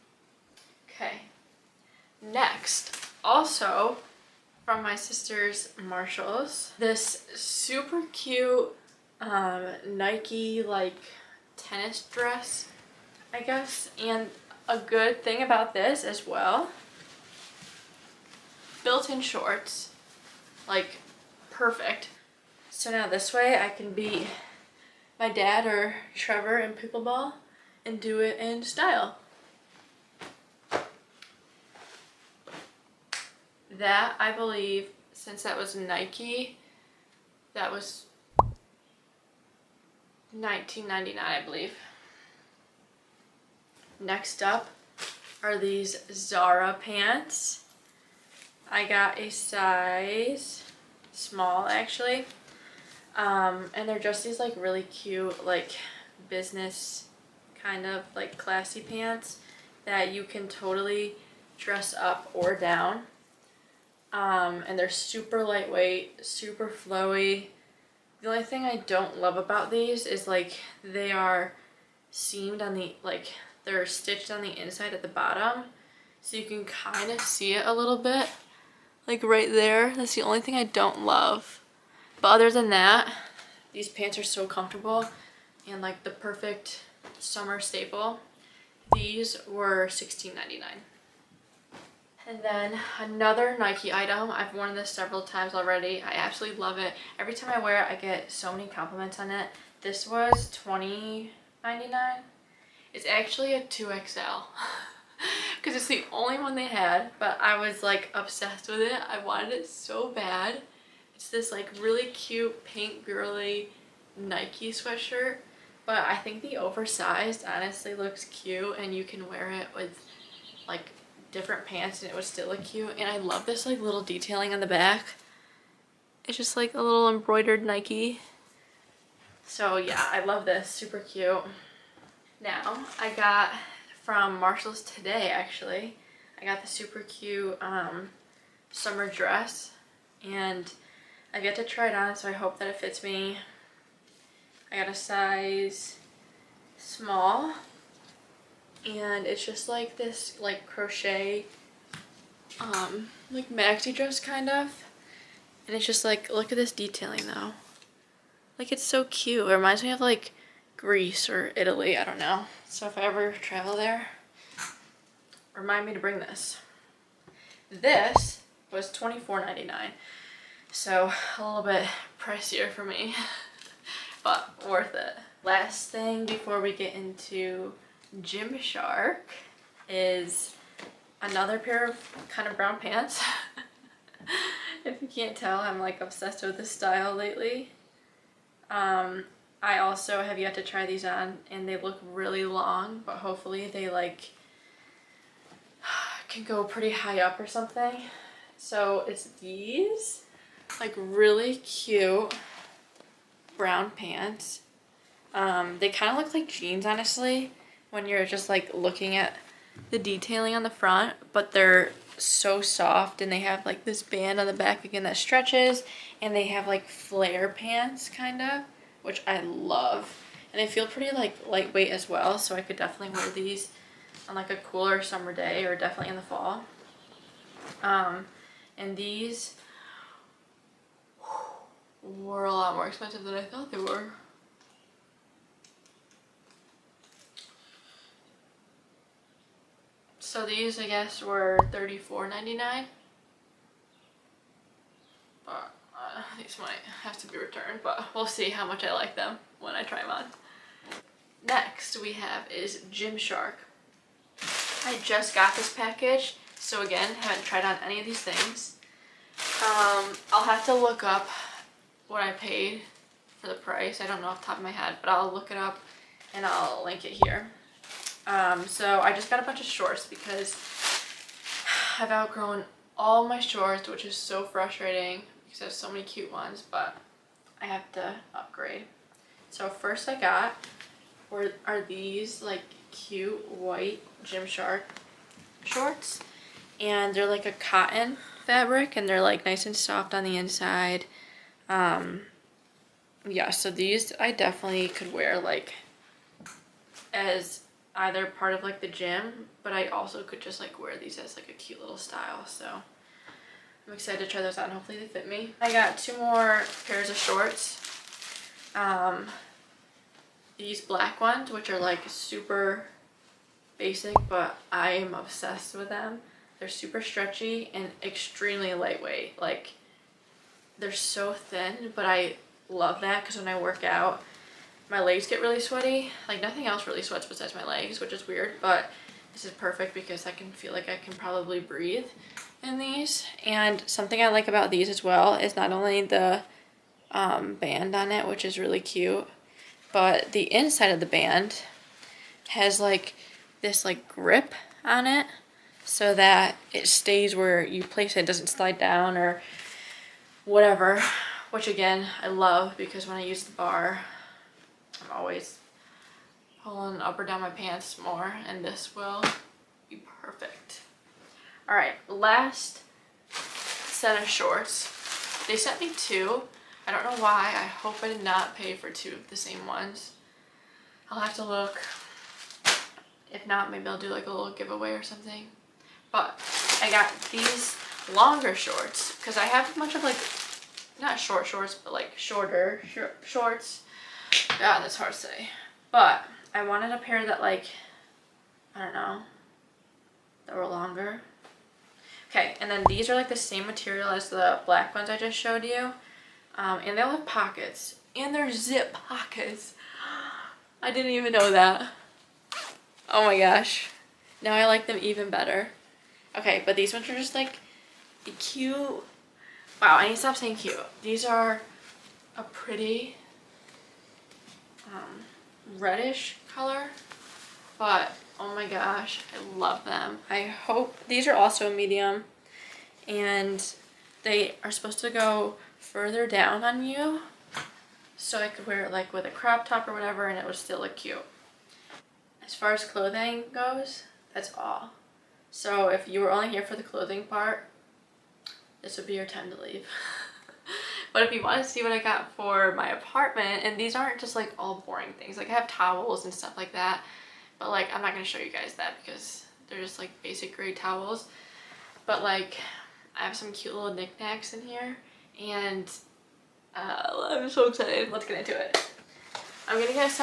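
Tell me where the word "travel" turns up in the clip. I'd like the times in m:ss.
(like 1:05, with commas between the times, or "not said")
2:43.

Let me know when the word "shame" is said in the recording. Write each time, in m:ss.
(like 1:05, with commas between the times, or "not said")
not said.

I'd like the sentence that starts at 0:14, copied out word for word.
And a good thing about this as well, built-in shorts, like perfect.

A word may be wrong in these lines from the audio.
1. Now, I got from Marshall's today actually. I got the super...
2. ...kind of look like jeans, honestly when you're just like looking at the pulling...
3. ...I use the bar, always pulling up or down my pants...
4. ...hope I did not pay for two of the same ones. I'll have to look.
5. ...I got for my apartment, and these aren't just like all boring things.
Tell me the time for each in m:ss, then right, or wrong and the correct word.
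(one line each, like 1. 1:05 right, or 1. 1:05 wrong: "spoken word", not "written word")
1. 2:12 right
2. 3:25 wrong: "detailing", not "pulling"
3. 5:53 right
4. 6:07 right
5. 7:21 right.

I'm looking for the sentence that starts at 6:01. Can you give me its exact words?
All right, last set of shorts.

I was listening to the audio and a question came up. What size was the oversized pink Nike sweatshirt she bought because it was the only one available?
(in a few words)
2XL.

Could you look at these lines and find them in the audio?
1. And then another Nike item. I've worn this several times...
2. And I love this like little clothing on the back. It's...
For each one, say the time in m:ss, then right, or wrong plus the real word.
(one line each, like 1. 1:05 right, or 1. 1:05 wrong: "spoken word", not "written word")
1. 1:32 right
2. 2:02 wrong: "detailing", not "clothing".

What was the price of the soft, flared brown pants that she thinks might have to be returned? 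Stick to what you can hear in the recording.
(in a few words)
$34.99.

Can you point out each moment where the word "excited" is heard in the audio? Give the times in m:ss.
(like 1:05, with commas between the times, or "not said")
5:03, 7:37.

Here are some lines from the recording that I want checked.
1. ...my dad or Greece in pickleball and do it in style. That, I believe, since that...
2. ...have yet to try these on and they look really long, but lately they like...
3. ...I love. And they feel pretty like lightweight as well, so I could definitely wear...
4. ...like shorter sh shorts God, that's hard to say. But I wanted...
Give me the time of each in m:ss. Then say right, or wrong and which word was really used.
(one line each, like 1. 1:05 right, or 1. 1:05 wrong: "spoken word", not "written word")
1. 0:25 wrong: "Trevor", not "Greece"
2. 3:10 wrong: "hopefully", not "lately"
3. 3:39 right
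4. 6:21 right.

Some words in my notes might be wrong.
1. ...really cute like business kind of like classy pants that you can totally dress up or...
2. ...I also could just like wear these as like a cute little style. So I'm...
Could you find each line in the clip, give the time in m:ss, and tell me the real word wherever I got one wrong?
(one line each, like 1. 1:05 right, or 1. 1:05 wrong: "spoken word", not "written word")
1. 0:54 right
2. 4:59 right.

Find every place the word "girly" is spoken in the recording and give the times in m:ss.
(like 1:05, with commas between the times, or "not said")
1:53.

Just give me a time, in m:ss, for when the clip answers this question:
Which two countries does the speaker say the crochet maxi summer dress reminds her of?
2:40.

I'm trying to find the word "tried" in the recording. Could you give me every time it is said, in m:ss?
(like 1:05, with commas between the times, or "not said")
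4:17.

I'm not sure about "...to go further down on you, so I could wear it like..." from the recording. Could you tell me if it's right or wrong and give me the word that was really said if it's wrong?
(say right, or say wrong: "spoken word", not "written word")
right.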